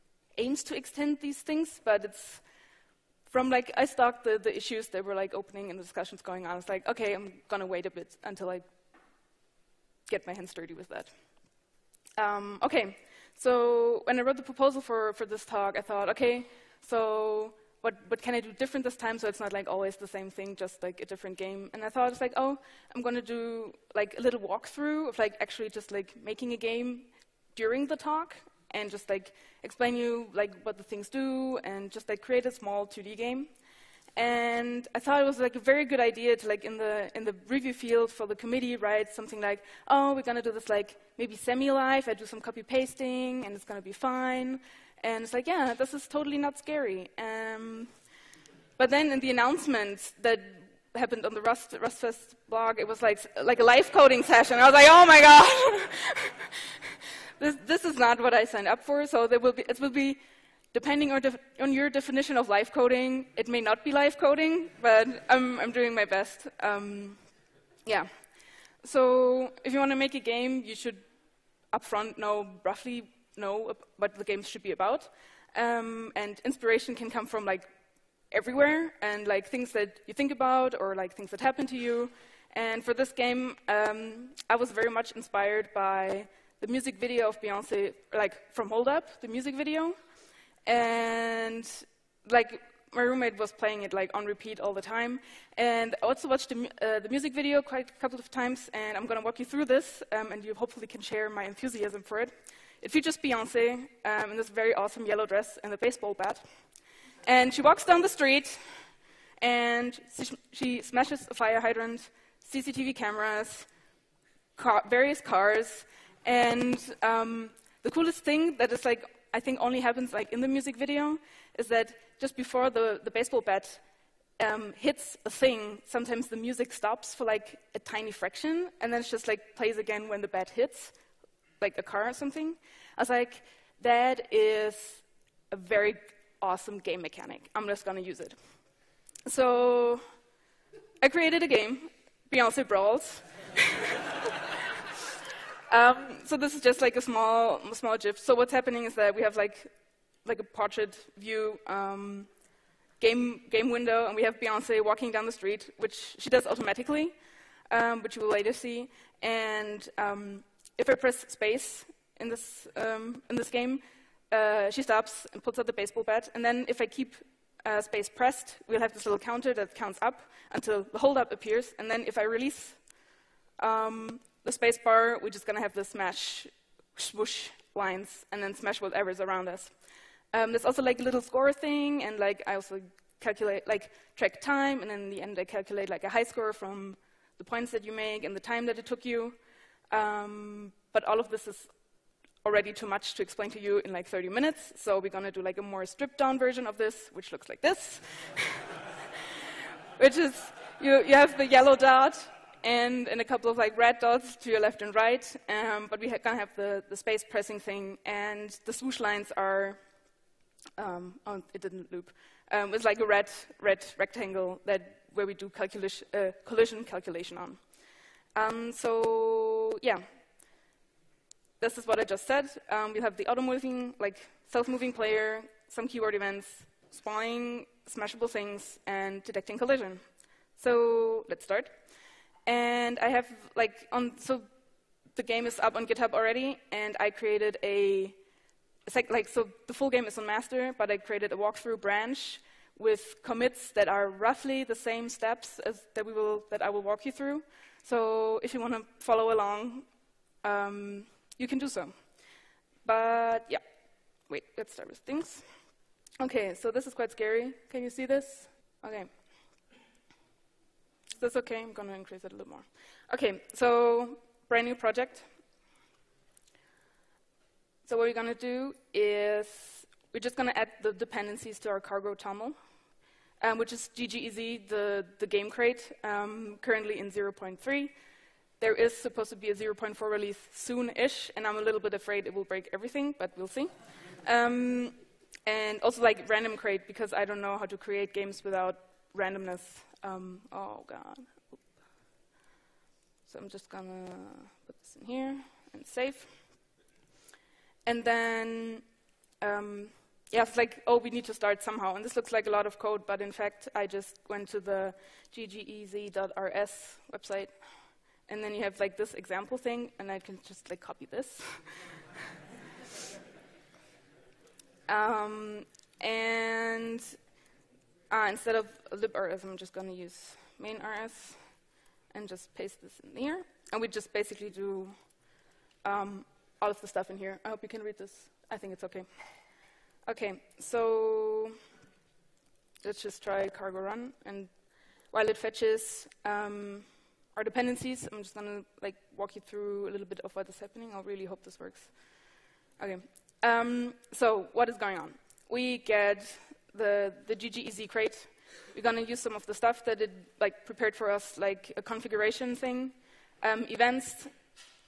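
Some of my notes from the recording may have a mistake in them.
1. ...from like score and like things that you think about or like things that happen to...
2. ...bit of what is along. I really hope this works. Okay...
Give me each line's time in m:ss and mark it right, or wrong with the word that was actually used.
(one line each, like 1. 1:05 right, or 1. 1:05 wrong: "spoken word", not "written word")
1. 1:17 wrong: "everywhere", not "score"
2. 5:40 wrong: "happening", not "along".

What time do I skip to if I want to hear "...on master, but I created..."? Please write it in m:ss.
4:00.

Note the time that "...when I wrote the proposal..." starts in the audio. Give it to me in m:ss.
0:14.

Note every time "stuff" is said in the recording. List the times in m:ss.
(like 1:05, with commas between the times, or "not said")
5:26, 5:49.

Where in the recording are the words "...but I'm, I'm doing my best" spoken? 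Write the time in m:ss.
1:04.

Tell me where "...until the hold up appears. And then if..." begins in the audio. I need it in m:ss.
2:50.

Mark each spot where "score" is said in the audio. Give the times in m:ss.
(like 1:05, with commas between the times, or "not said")
3:01, 3:06.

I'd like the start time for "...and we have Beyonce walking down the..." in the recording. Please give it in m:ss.
2:34.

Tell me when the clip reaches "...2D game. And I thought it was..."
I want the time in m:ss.
0:32.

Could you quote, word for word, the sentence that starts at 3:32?
Um, it's like a red red rectangle that where we do uh, collision calculation on.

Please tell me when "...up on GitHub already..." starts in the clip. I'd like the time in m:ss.
3:55.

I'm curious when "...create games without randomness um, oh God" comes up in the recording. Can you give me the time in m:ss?
4:47.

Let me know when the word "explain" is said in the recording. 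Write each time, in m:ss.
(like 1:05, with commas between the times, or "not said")
0:29, 3:13.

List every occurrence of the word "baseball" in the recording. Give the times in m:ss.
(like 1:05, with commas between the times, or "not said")
1:45, 2:03, 2:45.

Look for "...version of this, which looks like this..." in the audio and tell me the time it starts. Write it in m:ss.
3:16.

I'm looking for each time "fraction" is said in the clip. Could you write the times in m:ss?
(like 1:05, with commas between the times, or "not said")
2:08.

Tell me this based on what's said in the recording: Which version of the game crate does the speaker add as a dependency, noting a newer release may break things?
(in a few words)
0.3.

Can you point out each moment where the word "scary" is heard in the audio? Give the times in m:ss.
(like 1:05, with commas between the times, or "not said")
0:46, 4:17.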